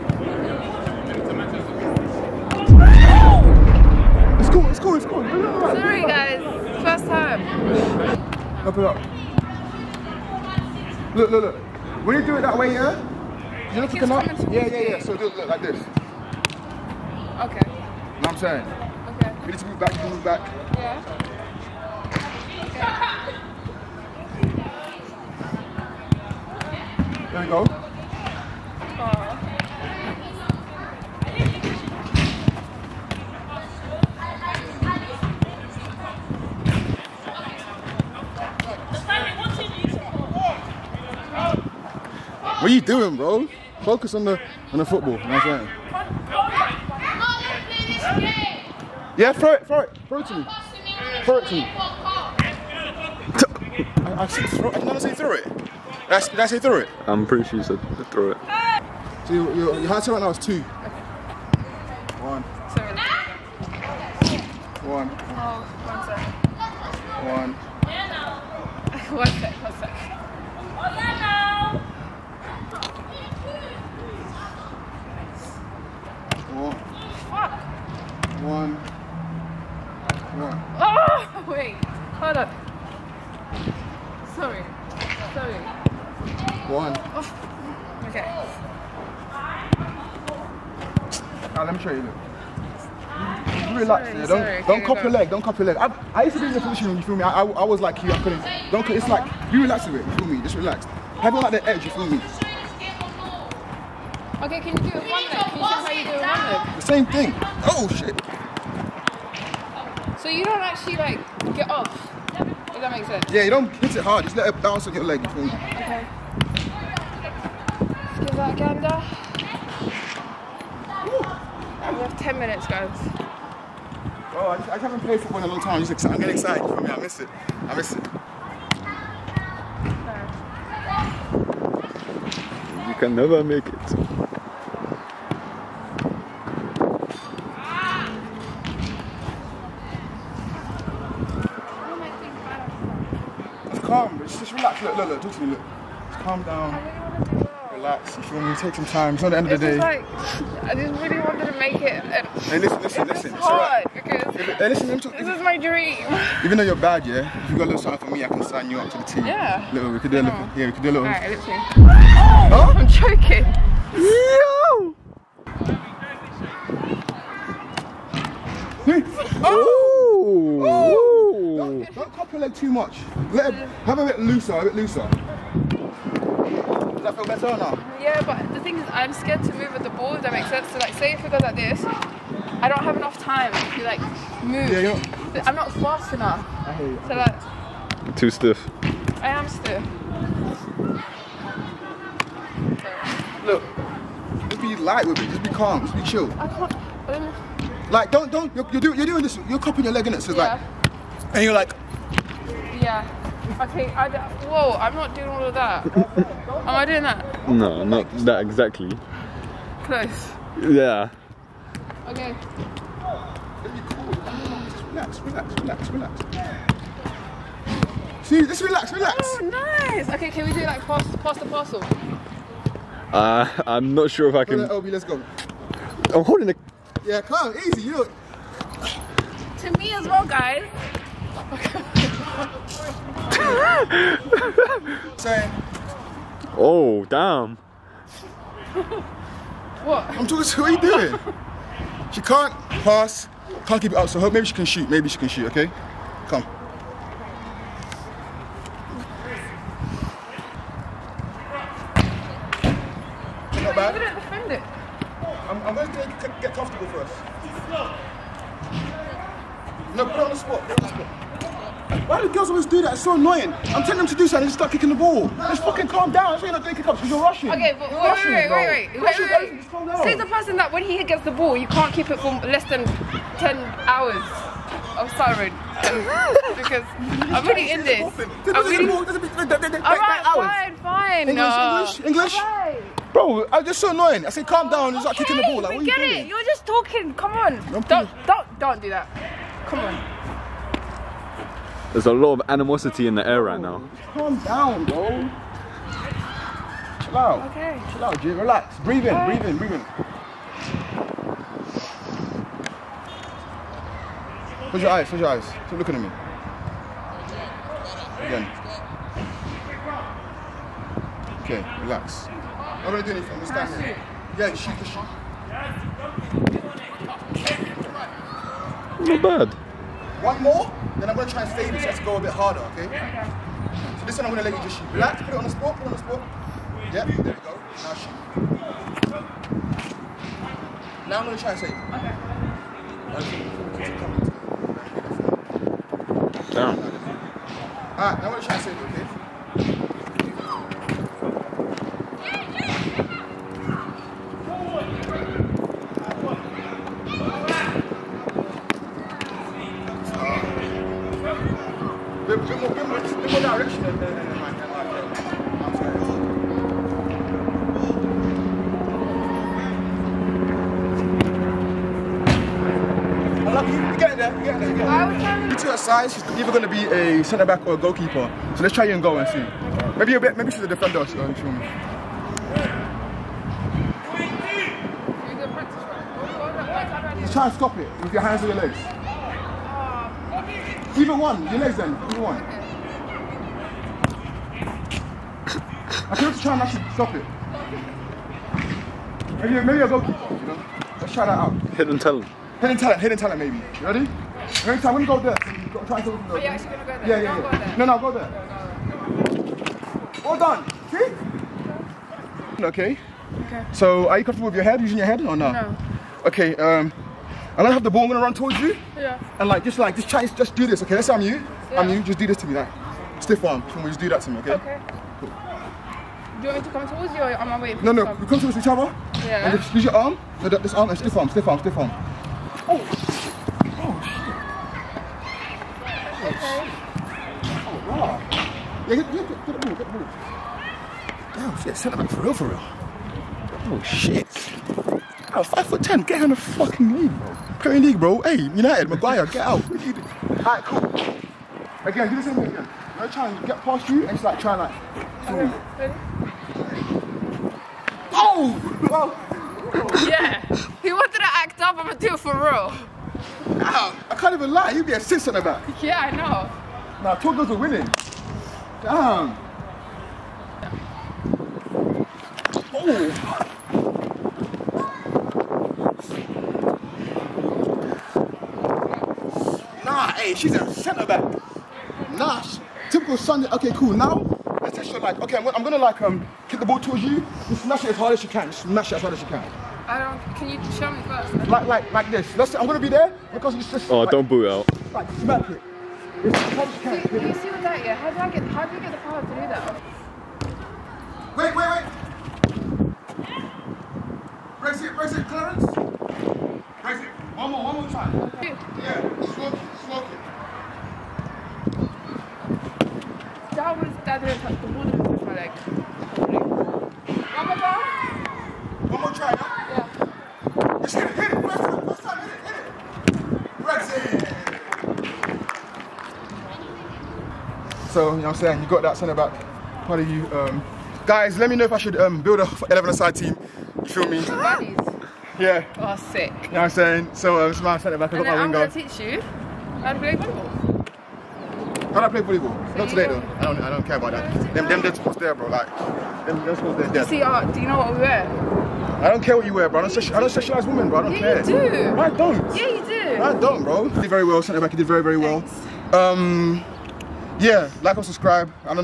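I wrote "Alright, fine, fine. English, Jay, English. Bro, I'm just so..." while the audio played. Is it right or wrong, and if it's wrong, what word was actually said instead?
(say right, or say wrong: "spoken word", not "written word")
wrong: "English", not "Jay".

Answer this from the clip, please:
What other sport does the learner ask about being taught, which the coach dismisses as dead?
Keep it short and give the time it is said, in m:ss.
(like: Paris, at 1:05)
Volleyball, at 8:52.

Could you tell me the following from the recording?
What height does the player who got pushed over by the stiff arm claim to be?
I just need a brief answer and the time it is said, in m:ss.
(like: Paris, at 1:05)
5 foot 10, at 7:15.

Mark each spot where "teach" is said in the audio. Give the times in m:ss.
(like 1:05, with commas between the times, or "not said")
8:48.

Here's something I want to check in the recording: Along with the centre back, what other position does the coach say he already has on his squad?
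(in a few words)
Winger.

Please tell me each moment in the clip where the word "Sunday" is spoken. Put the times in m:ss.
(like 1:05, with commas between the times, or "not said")
7:53.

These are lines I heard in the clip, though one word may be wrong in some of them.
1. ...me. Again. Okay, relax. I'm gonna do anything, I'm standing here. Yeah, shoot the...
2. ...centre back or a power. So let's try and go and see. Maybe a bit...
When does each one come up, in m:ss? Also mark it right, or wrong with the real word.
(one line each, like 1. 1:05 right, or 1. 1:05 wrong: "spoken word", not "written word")
1. 5:06 right
2. 6:07 wrong: "goalkeeper", not "power".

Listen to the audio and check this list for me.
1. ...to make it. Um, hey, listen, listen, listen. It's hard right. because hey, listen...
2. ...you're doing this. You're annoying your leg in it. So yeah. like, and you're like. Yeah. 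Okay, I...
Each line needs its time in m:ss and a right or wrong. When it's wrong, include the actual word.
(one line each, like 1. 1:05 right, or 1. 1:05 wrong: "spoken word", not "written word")
1. 2:31 right
2. 3:18 wrong: "cupping", not "annoying".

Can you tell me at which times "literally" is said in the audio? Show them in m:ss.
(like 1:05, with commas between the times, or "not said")
2:25, 2:41.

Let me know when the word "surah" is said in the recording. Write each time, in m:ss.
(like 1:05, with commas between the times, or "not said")
not said.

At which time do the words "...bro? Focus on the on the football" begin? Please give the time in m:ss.
0:43.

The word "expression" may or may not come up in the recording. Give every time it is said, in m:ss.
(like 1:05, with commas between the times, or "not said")
not said.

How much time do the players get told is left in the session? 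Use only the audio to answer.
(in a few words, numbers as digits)
10 minutes.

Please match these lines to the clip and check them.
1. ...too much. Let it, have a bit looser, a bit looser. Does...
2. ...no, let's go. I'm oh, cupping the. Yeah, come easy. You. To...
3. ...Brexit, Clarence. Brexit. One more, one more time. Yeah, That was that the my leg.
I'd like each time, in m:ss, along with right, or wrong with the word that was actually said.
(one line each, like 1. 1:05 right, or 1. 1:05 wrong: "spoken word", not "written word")
1. 2:52 right
2. 3:44 wrong: "holding", not "cupping"
3. 8:14 right.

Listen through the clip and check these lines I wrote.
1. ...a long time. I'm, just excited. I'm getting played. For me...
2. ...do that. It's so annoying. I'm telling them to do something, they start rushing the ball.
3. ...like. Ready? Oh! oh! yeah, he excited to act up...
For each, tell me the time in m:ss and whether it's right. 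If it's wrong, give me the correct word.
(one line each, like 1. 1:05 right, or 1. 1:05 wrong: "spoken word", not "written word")
1. 2:05 wrong: "excited", not "played"
2. 4:22 wrong: "kicking", not "rushing"
3. 7:24 wrong: "wanted", not "excited".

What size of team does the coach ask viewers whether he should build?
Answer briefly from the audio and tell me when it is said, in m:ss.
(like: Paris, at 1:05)
11-a-side, at 8:42.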